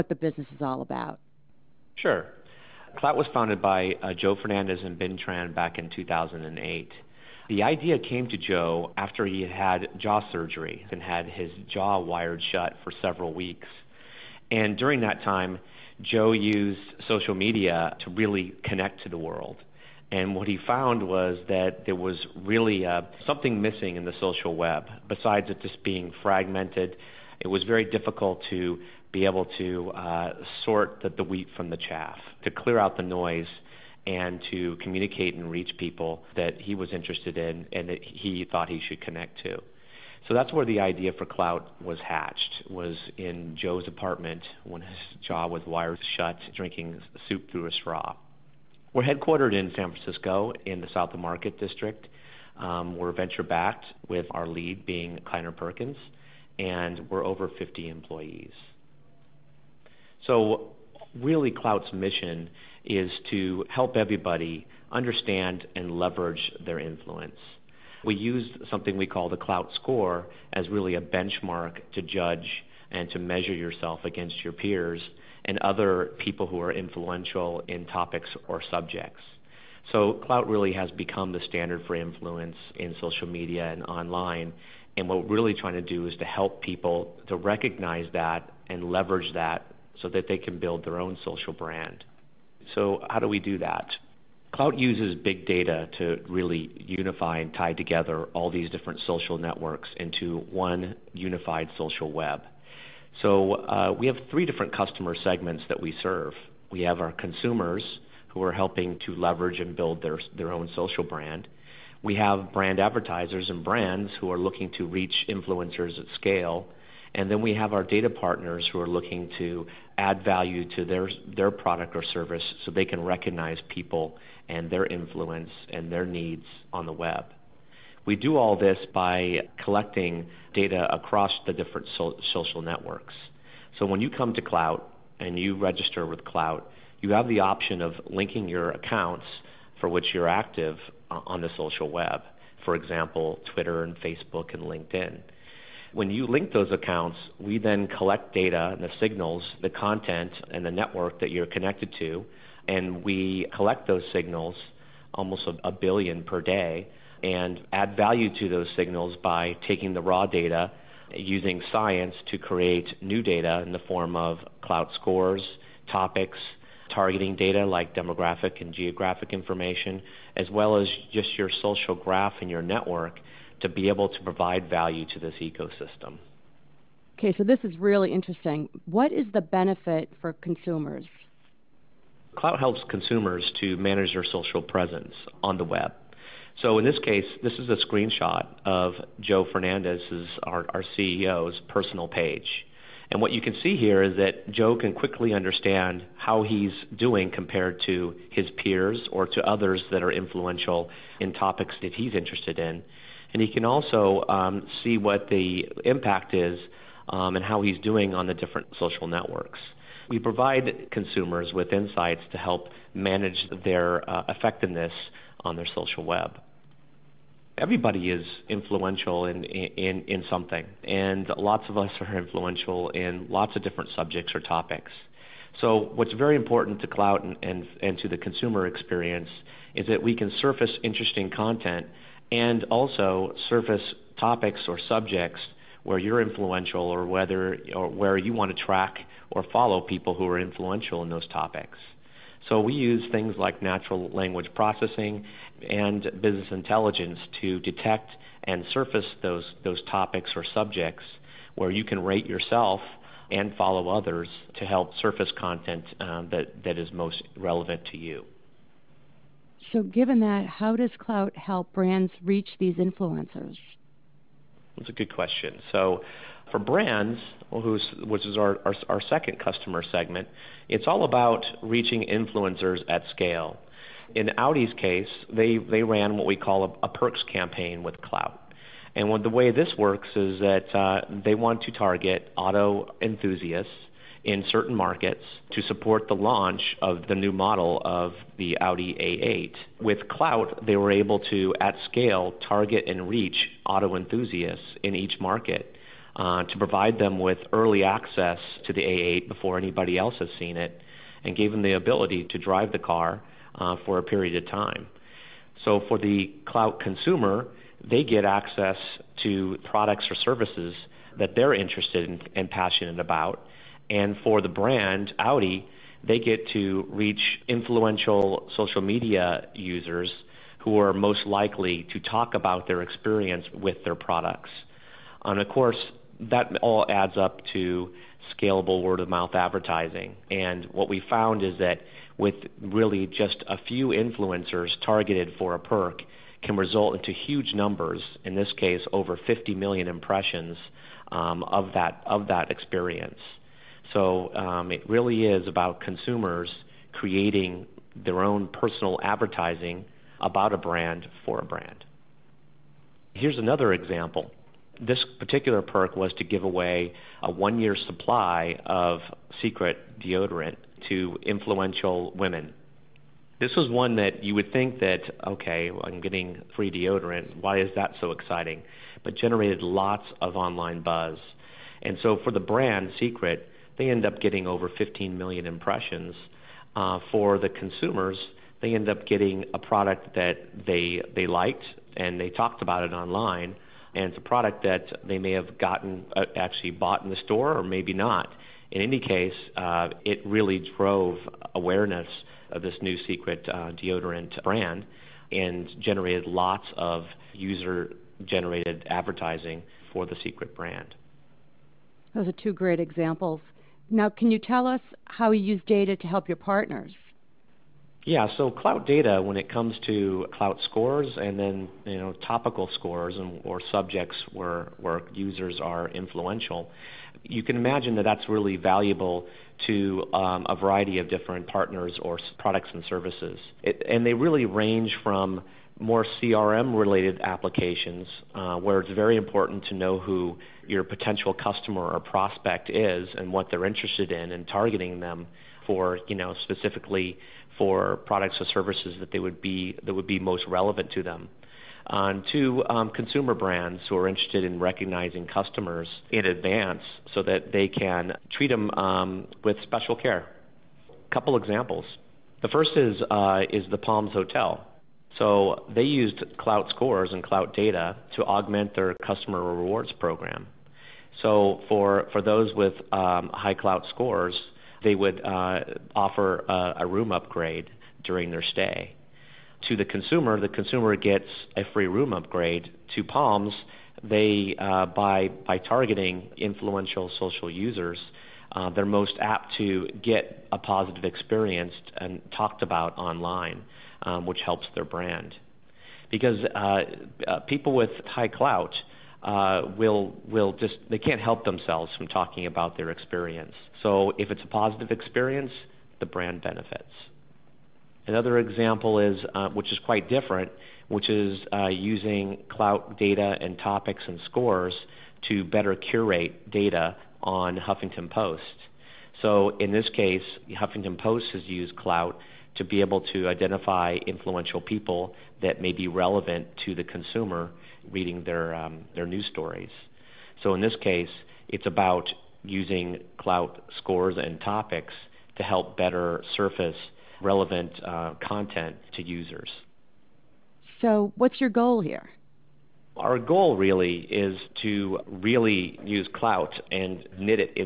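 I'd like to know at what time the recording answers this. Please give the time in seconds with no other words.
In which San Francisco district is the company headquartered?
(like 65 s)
50 s.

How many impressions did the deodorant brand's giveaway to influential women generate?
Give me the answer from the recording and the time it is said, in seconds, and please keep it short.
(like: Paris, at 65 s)
over 15 million, at 374 s.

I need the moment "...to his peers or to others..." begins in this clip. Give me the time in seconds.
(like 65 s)
197 s.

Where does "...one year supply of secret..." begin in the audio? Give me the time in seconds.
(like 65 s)
357 s.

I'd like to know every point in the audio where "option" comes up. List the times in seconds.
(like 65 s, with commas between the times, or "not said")
137 s.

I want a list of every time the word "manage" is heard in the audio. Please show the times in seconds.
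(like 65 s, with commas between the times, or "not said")
183 s, 212 s.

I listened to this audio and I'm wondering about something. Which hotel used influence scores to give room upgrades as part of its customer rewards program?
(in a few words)
Palms Hotel.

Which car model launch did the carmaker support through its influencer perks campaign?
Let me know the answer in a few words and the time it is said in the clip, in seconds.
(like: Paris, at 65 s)
Audi A8, at 288 s.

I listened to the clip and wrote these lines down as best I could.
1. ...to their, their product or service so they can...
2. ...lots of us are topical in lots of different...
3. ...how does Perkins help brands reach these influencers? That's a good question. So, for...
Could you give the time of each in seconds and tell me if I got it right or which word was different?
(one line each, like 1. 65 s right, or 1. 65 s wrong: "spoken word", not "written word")
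1. 120 s right
2. 221 s wrong: "influential", not "topical"
3. 260 s wrong: "Klout", not "Perkins".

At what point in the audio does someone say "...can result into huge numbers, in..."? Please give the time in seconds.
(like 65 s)
336 s.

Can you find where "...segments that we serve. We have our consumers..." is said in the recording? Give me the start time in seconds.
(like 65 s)
105 s.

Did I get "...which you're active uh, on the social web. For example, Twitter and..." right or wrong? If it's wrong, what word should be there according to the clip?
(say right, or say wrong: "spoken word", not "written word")
right.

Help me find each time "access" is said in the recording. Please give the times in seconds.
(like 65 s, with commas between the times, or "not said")
297 s, 308 s.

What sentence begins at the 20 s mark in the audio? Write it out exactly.
And what he found was that there was really uh, something missing in the social web.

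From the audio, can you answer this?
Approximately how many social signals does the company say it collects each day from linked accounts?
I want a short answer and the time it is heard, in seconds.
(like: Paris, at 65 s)
a billion, at 155 s.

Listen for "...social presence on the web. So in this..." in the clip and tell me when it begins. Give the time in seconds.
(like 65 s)
184 s.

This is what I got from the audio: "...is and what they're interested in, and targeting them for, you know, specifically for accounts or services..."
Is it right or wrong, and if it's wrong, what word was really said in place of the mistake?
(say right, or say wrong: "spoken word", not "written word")
wrong: "products", not "accounts".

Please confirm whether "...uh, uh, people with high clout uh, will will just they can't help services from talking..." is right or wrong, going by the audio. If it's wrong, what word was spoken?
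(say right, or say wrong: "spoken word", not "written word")
wrong: "themselves", not "services".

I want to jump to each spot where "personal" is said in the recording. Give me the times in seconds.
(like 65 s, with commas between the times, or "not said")
191 s, 348 s.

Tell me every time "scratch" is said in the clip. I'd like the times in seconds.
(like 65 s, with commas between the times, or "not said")
not said.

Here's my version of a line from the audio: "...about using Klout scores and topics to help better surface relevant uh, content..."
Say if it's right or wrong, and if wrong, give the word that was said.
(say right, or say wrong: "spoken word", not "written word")
right.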